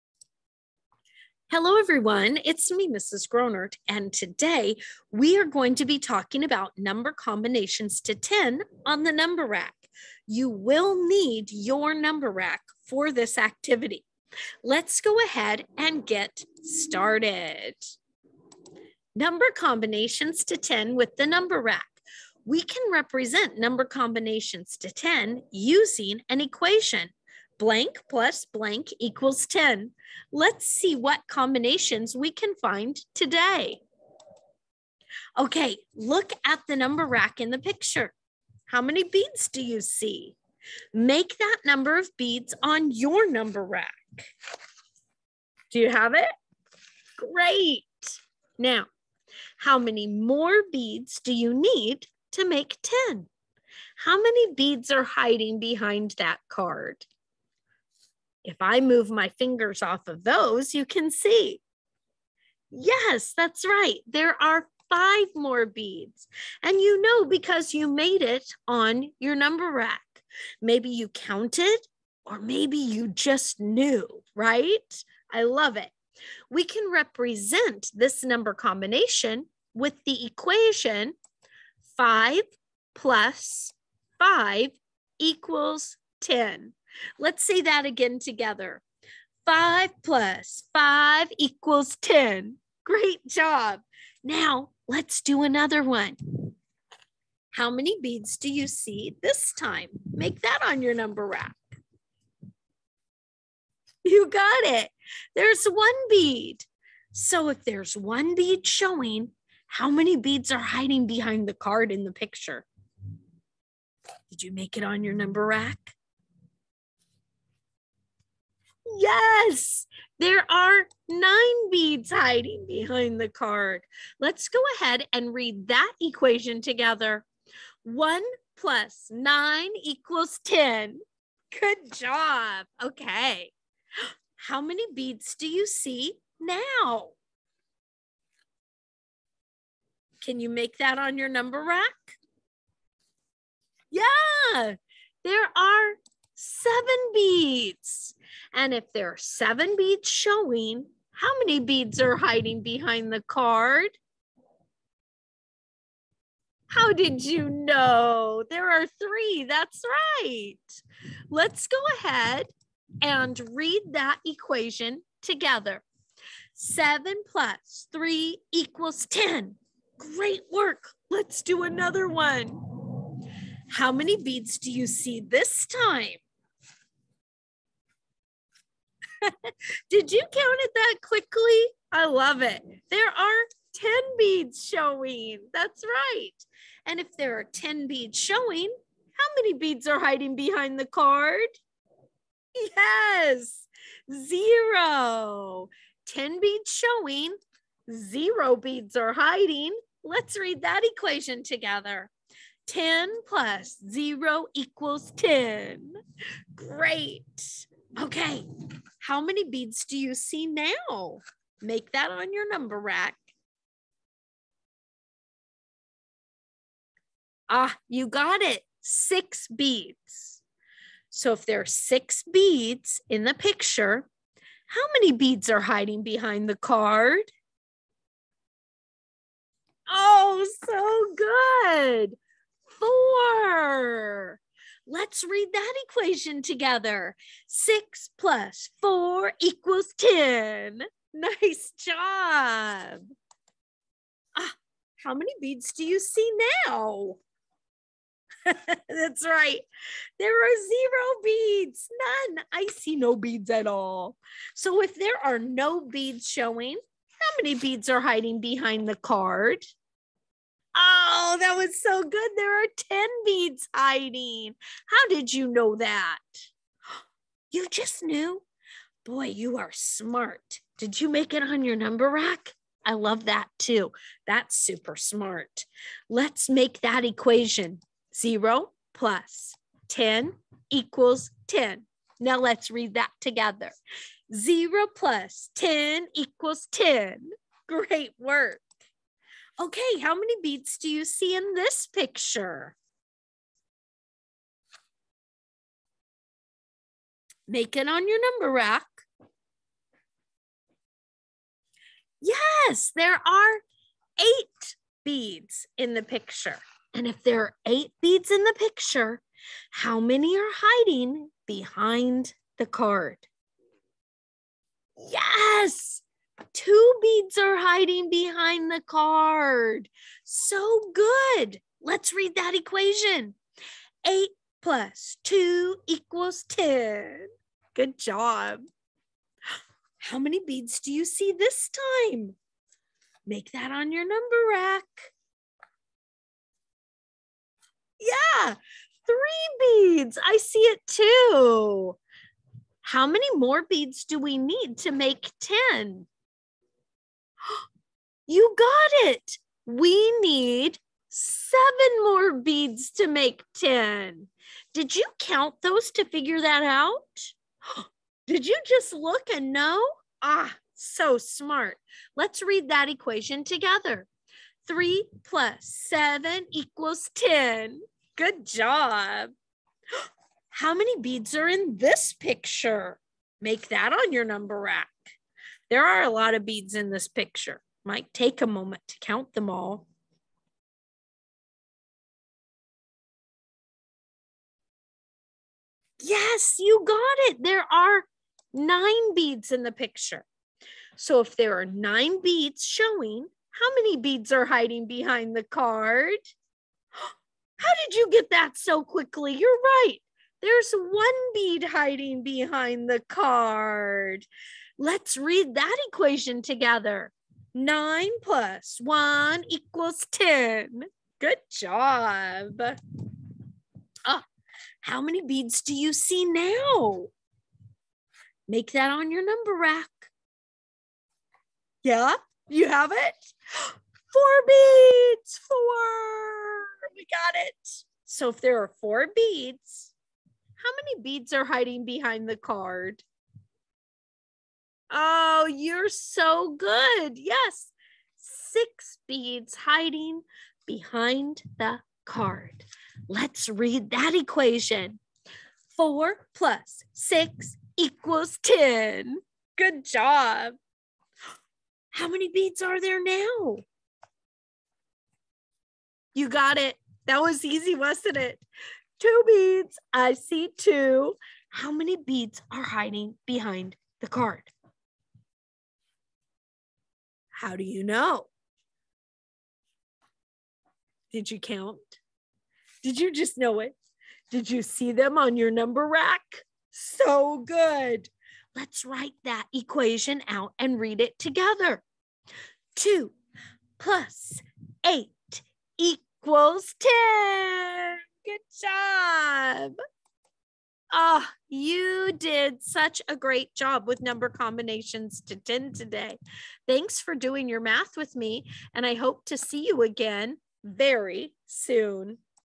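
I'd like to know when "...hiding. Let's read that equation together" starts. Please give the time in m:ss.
3:19.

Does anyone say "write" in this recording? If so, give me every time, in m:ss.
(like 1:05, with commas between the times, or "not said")
7:58.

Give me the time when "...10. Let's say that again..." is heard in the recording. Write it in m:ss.
1:26.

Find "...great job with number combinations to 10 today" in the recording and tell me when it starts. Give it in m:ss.
8:13.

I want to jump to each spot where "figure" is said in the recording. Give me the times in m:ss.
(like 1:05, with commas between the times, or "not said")
5:56.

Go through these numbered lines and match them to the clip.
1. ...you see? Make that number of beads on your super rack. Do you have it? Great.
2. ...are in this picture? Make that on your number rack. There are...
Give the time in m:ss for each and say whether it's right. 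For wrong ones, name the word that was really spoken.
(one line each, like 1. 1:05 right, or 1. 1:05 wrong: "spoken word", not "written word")
1. 0:39 wrong: "number", not "super"
2. 6:11 right.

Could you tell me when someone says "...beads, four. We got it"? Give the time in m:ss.
7:04.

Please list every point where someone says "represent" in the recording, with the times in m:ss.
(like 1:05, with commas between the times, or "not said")
0:22, 1:16.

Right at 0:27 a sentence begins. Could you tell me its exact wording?
Blank plus blank equals 10 Let's see what combinations we can find today.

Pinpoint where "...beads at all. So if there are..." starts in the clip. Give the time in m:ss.
4:13.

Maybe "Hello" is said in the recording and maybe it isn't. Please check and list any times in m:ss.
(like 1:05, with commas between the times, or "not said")
0:01.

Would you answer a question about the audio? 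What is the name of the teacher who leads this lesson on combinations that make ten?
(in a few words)
Mrs. Gronnert.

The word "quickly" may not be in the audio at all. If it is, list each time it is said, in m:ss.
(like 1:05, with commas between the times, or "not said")
3:01, 6:38.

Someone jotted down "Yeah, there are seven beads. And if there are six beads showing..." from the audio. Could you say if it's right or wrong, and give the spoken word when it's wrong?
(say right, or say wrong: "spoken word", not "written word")
wrong: "seven", not "six".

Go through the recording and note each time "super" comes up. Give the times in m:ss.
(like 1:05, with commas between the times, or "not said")
4:34.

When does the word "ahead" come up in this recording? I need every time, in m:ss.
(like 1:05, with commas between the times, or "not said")
0:15, 2:04, 2:41.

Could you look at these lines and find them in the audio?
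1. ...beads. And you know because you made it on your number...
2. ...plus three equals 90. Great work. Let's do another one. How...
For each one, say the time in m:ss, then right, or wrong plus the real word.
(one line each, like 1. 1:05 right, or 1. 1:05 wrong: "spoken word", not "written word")
1. 1:05 right
2. 2:47 wrong: "10", not "90".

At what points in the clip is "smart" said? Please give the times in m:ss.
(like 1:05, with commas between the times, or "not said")
4:29, 4:34, 6:01.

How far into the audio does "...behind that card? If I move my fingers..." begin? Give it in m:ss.
0:55.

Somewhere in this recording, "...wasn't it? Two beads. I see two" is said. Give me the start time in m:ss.
7:37.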